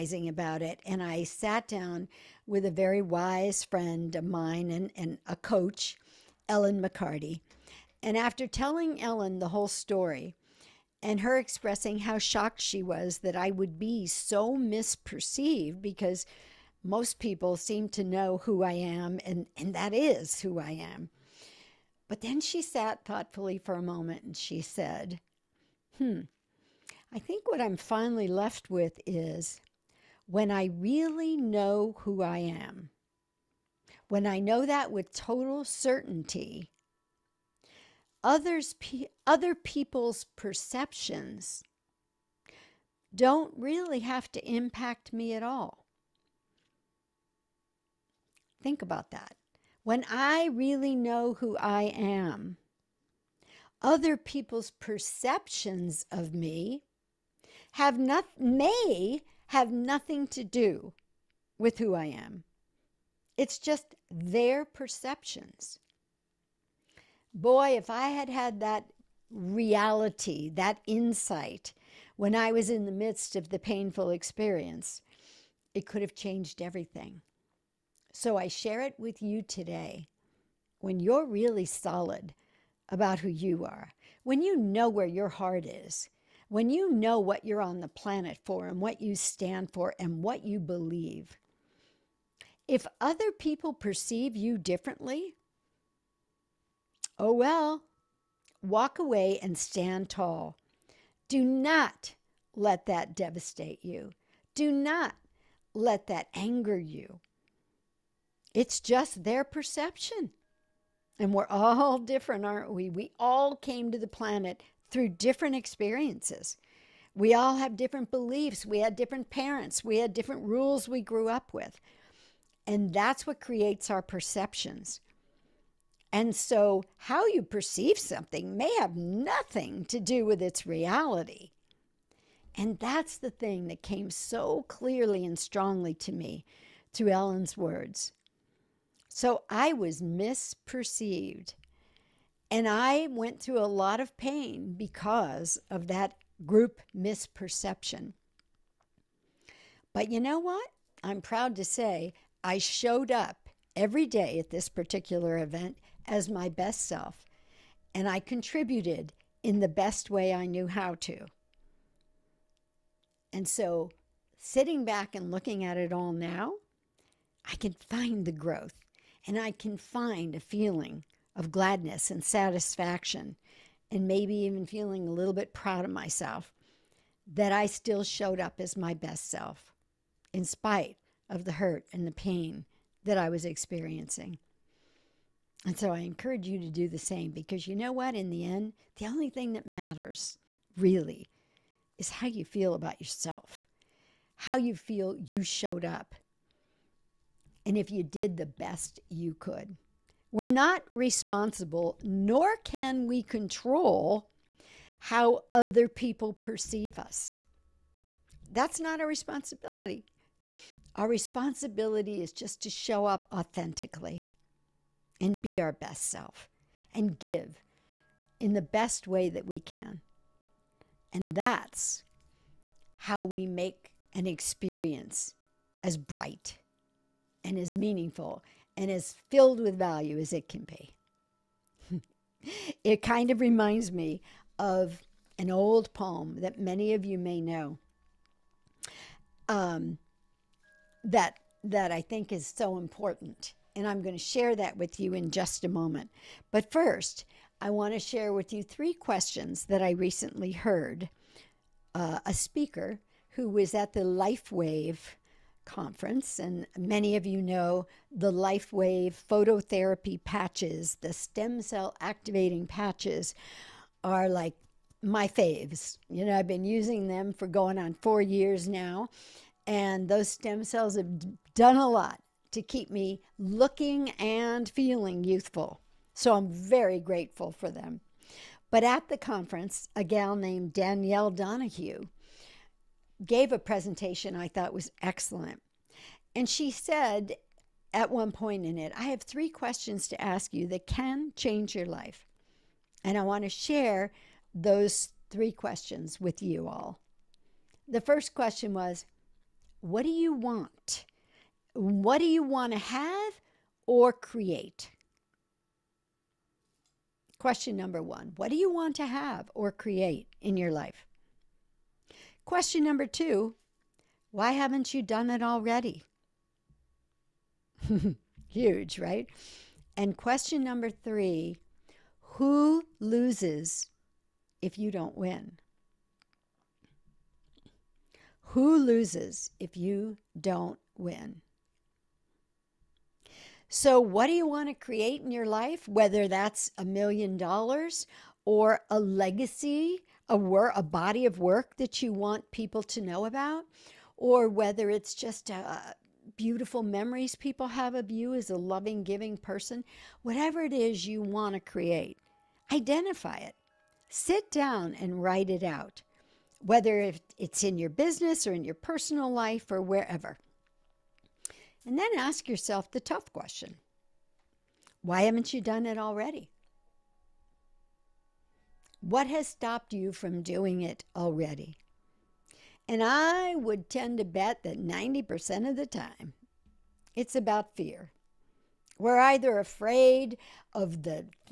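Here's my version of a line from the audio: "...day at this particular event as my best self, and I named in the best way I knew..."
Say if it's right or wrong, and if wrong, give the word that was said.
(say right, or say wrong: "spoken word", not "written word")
wrong: "contributed", not "named".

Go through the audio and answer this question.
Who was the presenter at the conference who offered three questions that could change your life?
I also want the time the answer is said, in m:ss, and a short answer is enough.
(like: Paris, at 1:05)
Danielle Donahue, at 4:40.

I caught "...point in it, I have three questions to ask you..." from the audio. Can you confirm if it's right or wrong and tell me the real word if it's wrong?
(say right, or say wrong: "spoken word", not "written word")
right.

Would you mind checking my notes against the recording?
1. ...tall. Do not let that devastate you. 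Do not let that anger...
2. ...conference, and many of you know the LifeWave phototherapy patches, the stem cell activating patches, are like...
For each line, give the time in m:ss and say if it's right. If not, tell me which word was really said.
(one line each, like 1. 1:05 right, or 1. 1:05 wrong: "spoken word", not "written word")
1. 1:40 right
2. 4:15 right.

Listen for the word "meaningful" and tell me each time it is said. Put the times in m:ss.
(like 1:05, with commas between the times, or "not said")
3:47.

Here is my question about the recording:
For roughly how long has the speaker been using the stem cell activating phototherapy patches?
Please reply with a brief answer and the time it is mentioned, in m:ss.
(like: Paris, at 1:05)
4 years, at 4:27.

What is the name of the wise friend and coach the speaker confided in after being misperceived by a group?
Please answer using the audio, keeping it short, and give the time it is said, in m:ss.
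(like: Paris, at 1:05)
Ellen McCarty, at 0:06.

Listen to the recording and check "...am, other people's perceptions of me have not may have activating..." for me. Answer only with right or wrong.
wrong.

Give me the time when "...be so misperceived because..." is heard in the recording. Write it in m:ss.
0:13.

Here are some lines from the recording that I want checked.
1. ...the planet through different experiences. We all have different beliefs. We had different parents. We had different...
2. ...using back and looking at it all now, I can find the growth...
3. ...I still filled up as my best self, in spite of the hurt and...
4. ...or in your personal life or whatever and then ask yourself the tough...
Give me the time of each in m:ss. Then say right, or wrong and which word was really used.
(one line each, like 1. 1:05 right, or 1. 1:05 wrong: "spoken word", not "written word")
1. 1:53 right
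2. 2:44 wrong: "sitting", not "using"
3. 2:57 wrong: "showed", not "filled"
4. 5:58 wrong: "wherever", not "whatever".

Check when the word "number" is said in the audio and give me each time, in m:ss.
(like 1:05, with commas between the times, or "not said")
5:07, 5:12, 5:20.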